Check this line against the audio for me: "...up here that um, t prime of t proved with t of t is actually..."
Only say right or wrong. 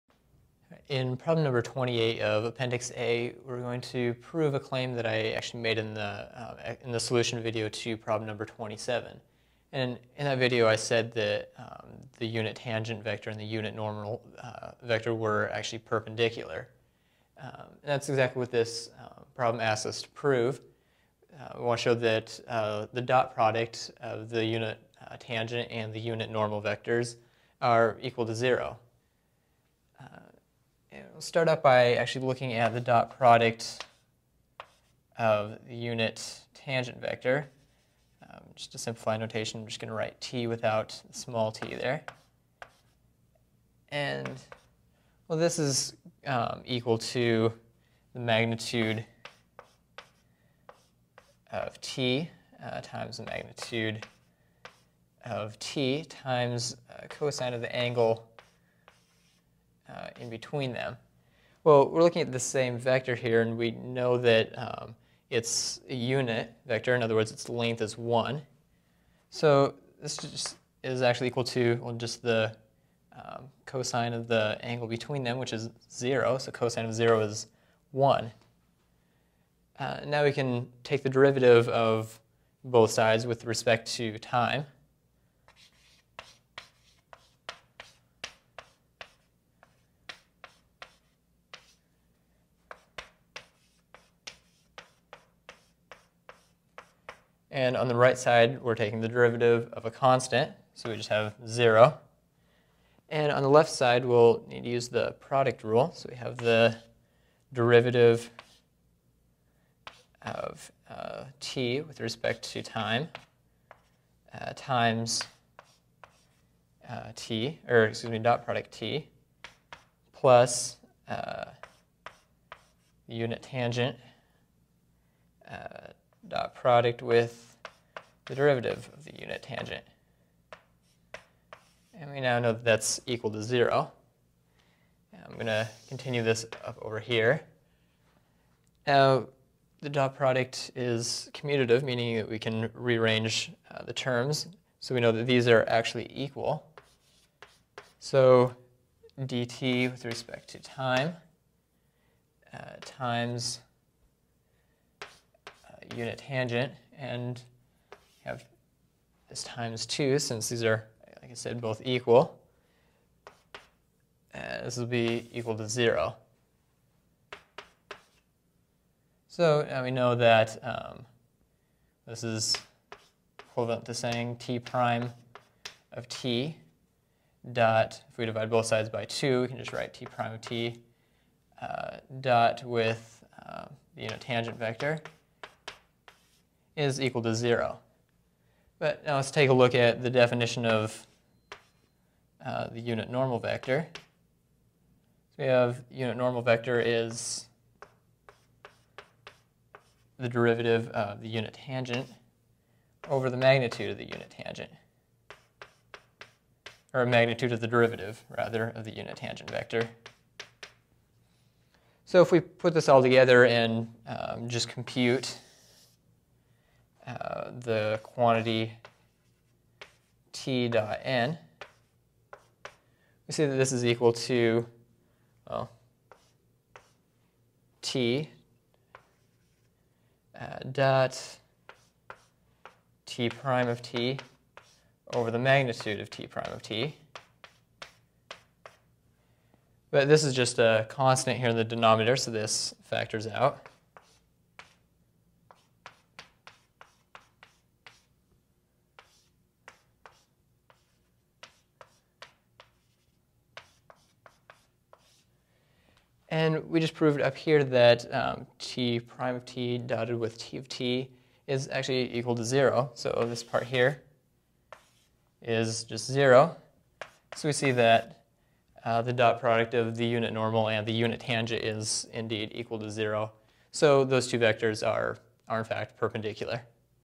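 wrong.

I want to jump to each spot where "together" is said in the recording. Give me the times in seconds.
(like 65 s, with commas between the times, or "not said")
213 s.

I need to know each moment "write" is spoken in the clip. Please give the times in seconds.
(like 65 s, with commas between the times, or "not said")
39 s, 179 s.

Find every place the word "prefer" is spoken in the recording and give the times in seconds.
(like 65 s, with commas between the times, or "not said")
not said.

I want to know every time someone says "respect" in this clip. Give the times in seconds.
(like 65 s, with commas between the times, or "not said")
83 s, 111 s, 150 s.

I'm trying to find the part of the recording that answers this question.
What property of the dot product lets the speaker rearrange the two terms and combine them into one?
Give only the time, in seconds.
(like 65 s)
141 s.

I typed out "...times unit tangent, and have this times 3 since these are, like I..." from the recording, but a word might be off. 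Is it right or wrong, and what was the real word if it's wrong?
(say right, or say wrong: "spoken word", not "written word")
wrong: "2", not "3".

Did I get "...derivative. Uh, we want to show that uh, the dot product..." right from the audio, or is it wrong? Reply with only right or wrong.
wrong.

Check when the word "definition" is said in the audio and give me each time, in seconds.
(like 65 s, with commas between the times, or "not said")
190 s.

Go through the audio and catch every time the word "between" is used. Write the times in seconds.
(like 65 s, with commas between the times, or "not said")
60 s, 74 s.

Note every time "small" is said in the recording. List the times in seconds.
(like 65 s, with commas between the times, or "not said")
41 s.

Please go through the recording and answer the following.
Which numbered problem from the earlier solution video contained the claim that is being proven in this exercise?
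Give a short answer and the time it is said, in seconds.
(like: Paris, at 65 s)
27, at 7 s.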